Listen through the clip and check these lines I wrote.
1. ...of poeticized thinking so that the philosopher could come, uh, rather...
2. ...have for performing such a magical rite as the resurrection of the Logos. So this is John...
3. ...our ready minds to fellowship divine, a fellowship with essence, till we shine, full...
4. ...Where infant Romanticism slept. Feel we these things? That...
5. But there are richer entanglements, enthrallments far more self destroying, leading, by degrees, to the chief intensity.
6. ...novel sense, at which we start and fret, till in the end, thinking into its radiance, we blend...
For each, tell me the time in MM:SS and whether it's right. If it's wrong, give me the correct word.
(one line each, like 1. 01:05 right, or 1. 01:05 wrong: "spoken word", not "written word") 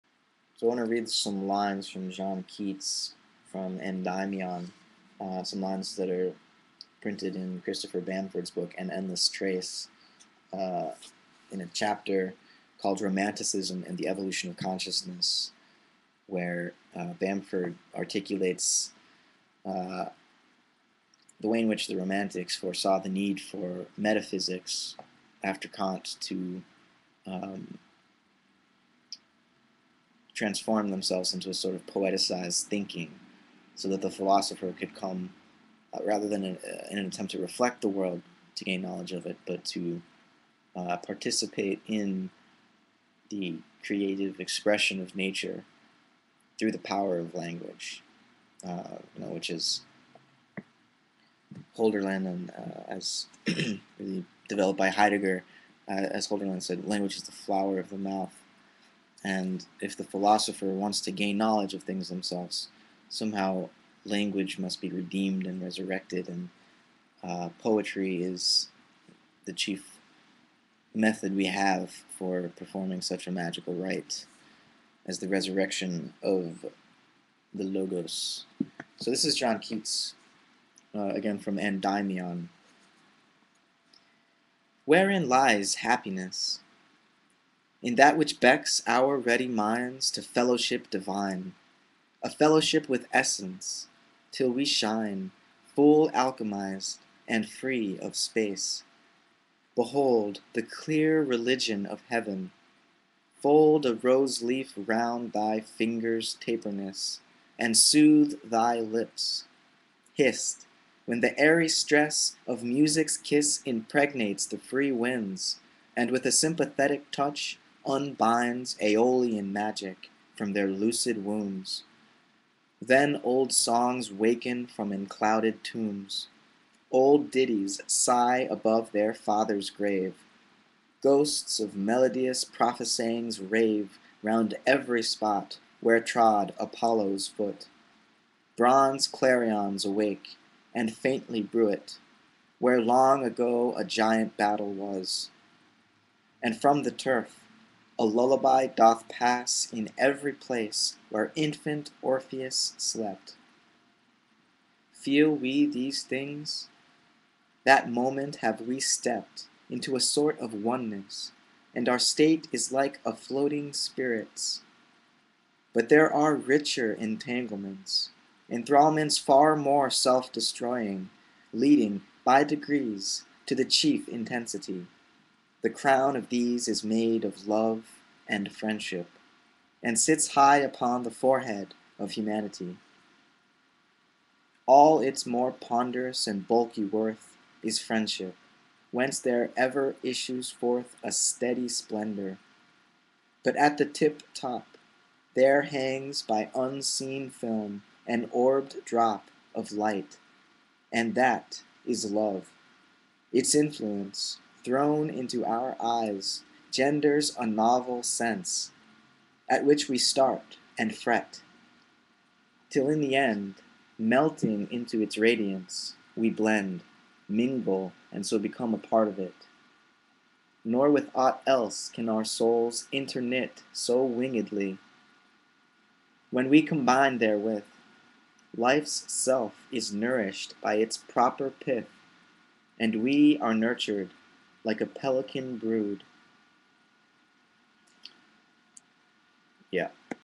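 1. 00:31 right
2. 01:11 right
3. 01:28 right
4. 02:31 wrong: "Orpheus", not "Romanticism"
5. 02:45 right
6. 03:27 wrong: "melting", not "thinking".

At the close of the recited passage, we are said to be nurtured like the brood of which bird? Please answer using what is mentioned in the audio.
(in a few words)
pelican.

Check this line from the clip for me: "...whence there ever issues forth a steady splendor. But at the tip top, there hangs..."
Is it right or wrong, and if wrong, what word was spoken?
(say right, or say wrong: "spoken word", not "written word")
right.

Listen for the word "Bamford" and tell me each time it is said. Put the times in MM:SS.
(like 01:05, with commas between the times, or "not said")
00:07, 00:17.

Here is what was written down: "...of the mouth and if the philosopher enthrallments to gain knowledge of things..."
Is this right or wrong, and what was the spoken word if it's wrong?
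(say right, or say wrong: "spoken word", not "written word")
wrong: "wants", not "enthrallments".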